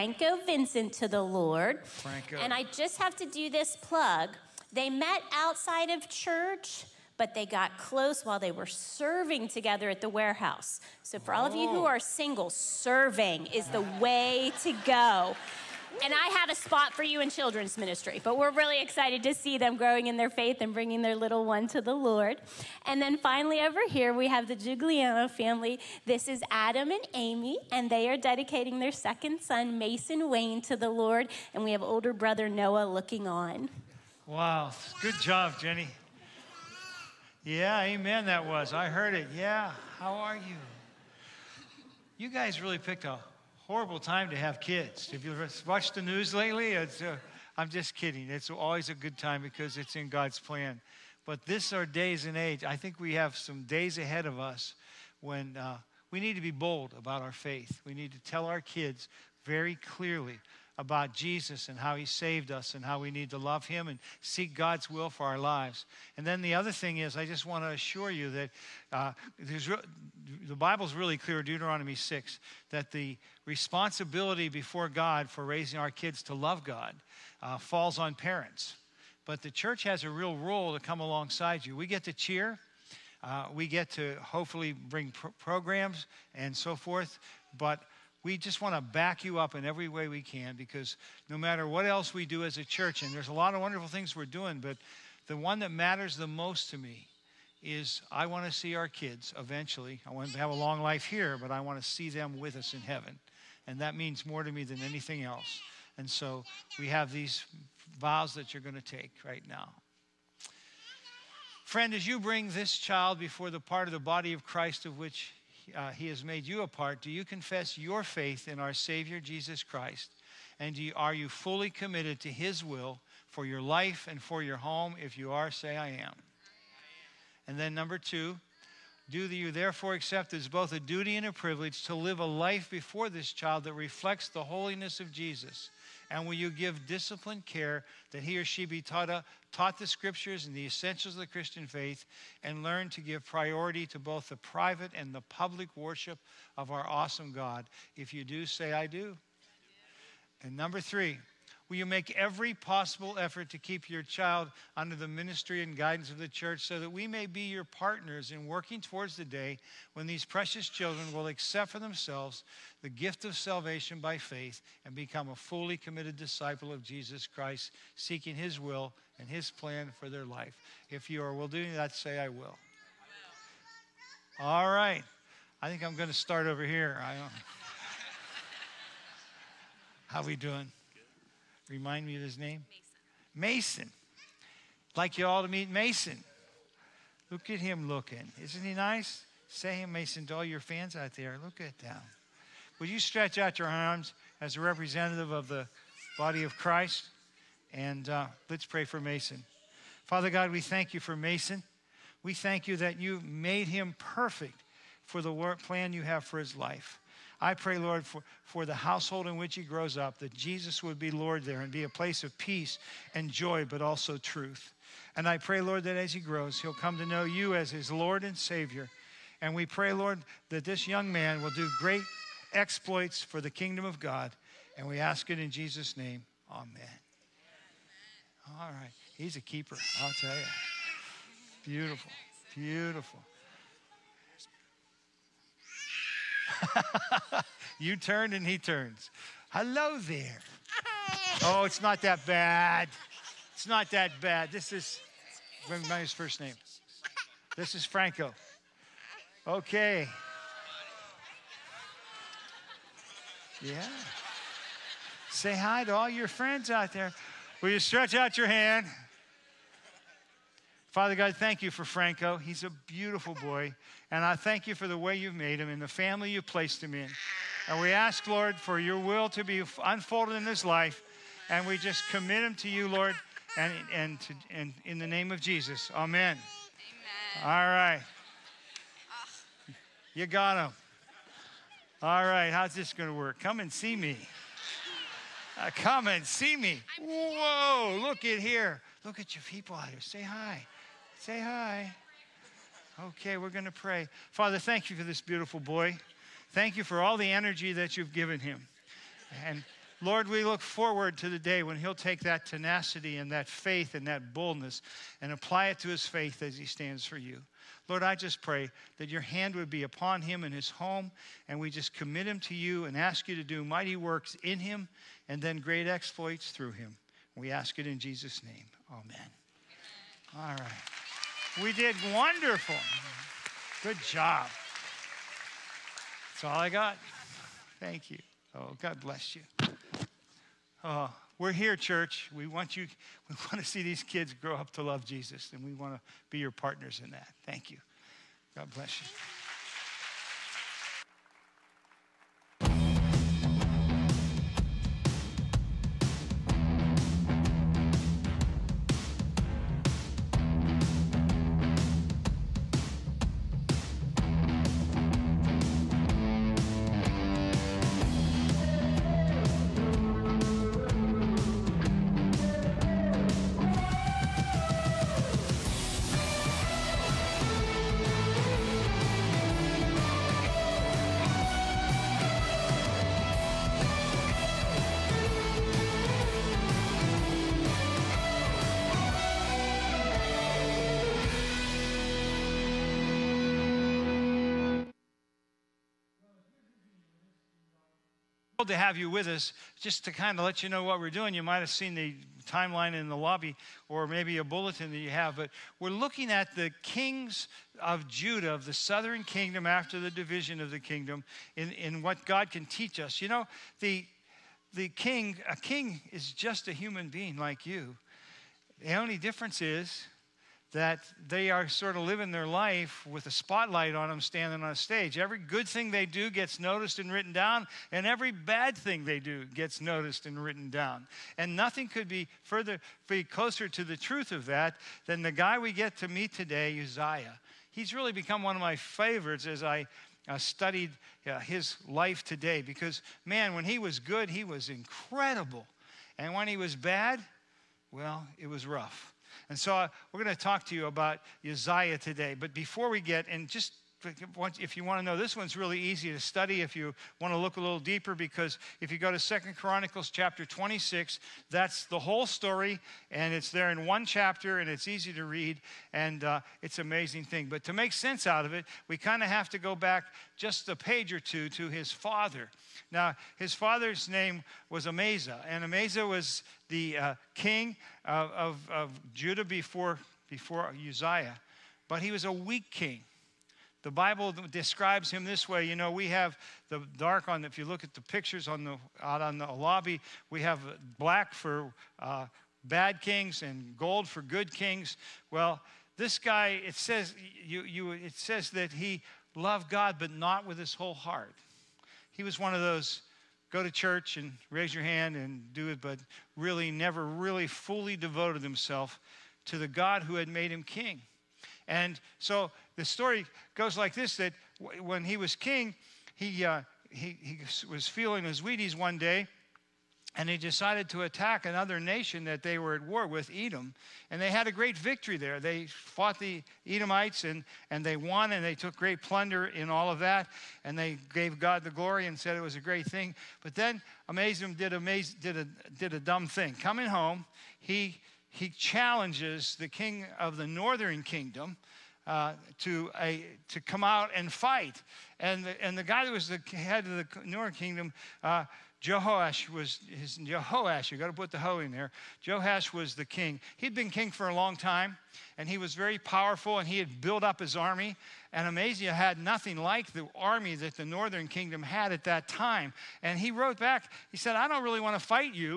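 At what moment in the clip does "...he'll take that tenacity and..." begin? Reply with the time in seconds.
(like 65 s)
301 s.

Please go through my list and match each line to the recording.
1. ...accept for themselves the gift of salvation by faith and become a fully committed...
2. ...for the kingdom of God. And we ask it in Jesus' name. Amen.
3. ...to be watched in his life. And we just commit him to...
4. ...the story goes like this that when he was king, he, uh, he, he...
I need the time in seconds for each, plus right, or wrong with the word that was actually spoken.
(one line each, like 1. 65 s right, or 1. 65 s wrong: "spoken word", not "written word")
1. 161 s right
2. 223 s right
3. 269 s wrong: "unfolded", not "watched"
4. 502 s right.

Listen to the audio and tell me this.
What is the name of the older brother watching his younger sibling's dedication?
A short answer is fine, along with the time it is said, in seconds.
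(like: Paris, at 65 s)
Noah, at 32 s.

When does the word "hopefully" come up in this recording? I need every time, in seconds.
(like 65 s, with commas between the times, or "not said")
84 s.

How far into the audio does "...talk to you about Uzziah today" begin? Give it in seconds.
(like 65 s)
440 s.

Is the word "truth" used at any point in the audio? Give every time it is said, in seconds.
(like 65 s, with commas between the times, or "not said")
214 s, 423 s.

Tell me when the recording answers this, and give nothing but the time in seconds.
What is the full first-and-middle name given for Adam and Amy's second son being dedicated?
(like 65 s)
29 s.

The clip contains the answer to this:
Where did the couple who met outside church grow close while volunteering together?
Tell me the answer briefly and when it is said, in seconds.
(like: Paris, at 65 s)
the warehouse, at 10 s.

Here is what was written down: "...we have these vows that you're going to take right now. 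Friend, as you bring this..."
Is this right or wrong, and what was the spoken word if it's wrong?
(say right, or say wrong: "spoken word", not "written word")
right.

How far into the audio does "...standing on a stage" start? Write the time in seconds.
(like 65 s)
414 s.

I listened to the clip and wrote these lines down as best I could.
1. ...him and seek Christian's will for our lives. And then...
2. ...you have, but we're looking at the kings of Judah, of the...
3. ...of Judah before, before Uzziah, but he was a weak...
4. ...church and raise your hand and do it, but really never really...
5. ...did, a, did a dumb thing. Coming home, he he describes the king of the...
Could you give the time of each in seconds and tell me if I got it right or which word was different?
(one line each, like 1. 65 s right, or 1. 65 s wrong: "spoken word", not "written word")
1. 63 s wrong: "God", not "Christian"
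2. 394 s right
3. 468 s right
4. 493 s right
5. 525 s wrong: "challenges", not "describes".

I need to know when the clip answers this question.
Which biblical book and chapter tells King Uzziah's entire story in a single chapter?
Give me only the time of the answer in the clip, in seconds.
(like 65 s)
449 s.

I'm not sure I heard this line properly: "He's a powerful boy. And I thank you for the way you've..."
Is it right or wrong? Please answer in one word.
wrong.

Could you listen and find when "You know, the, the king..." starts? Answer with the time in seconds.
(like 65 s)
403 s.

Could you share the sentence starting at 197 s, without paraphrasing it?
And uh, let's pray for Mason.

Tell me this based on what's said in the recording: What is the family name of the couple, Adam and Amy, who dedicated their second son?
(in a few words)
Giuliano.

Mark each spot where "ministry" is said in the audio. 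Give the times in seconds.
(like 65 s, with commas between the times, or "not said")
17 s, 155 s.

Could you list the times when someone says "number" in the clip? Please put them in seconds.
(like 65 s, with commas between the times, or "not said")
127 s, 150 s.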